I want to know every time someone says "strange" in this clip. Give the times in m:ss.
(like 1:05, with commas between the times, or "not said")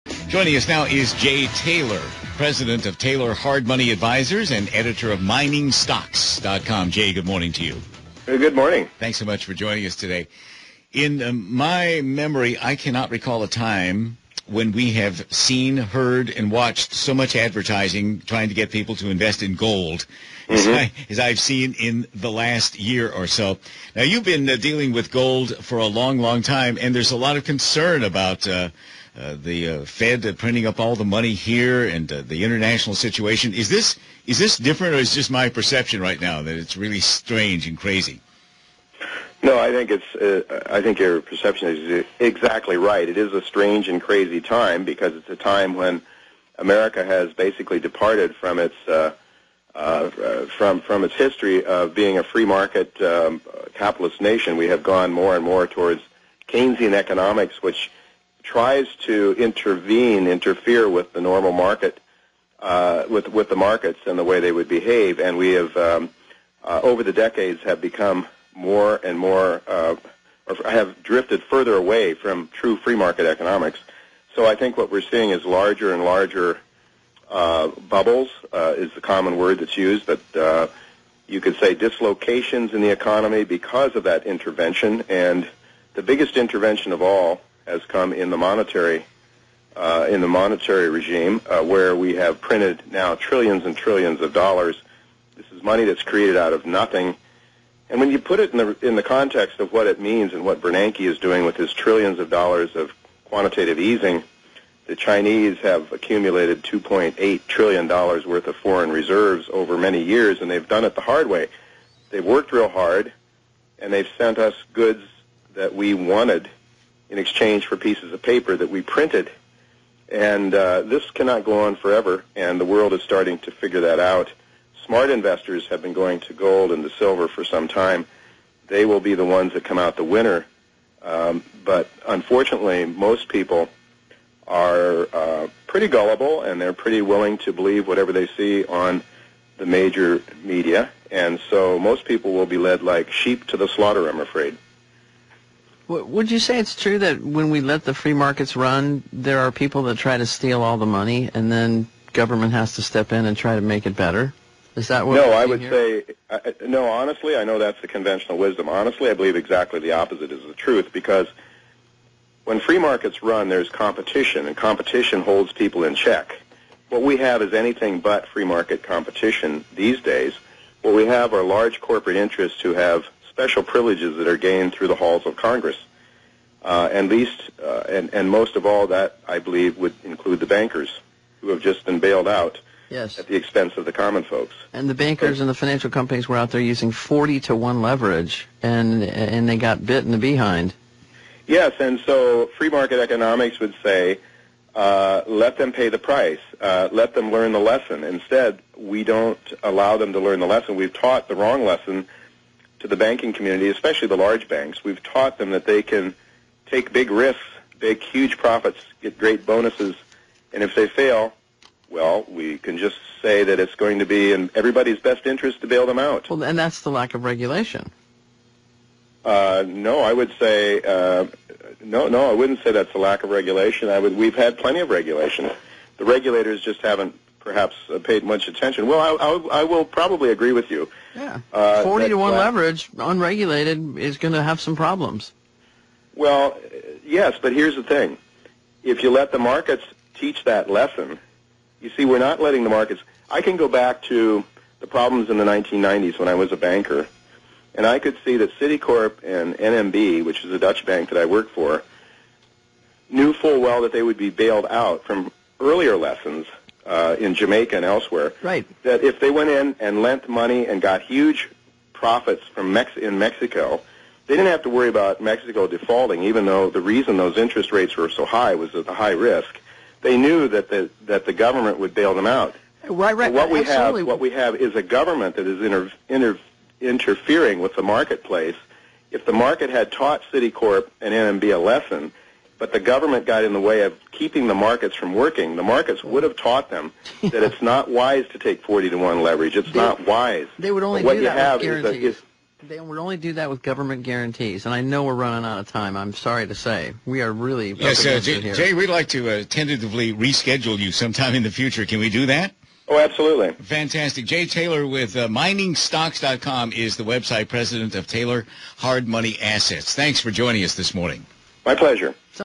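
0:37, 0:43.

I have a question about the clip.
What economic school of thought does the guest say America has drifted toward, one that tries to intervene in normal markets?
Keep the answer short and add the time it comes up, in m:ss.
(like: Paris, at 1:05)
Keynesian economics, at 0:56.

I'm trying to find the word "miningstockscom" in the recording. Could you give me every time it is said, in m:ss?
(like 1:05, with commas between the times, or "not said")
0:05, 5:05.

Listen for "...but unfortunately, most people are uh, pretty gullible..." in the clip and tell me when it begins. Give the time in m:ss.
2:11.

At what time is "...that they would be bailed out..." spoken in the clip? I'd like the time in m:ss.
4:13.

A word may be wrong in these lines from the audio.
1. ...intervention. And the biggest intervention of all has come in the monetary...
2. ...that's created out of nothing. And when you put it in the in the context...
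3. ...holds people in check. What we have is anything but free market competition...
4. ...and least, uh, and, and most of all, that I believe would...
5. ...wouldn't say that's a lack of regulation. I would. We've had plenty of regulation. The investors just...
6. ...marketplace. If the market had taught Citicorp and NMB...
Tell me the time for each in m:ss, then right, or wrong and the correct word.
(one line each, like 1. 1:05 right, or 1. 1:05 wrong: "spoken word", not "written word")
1. 1:24 right
2. 1:35 right
3. 2:45 right
4. 2:56 right
5. 3:42 wrong: "regulators", not "investors"
6. 4:37 right.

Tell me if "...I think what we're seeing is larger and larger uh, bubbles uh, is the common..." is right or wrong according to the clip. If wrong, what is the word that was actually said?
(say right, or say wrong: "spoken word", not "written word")
right.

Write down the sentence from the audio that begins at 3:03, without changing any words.
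at the expense of the common folks.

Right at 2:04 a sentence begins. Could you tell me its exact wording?
Smart investors have been going to gold and to silver for some time.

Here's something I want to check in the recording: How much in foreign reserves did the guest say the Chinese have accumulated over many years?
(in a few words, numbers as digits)
2.8 trillion dollars.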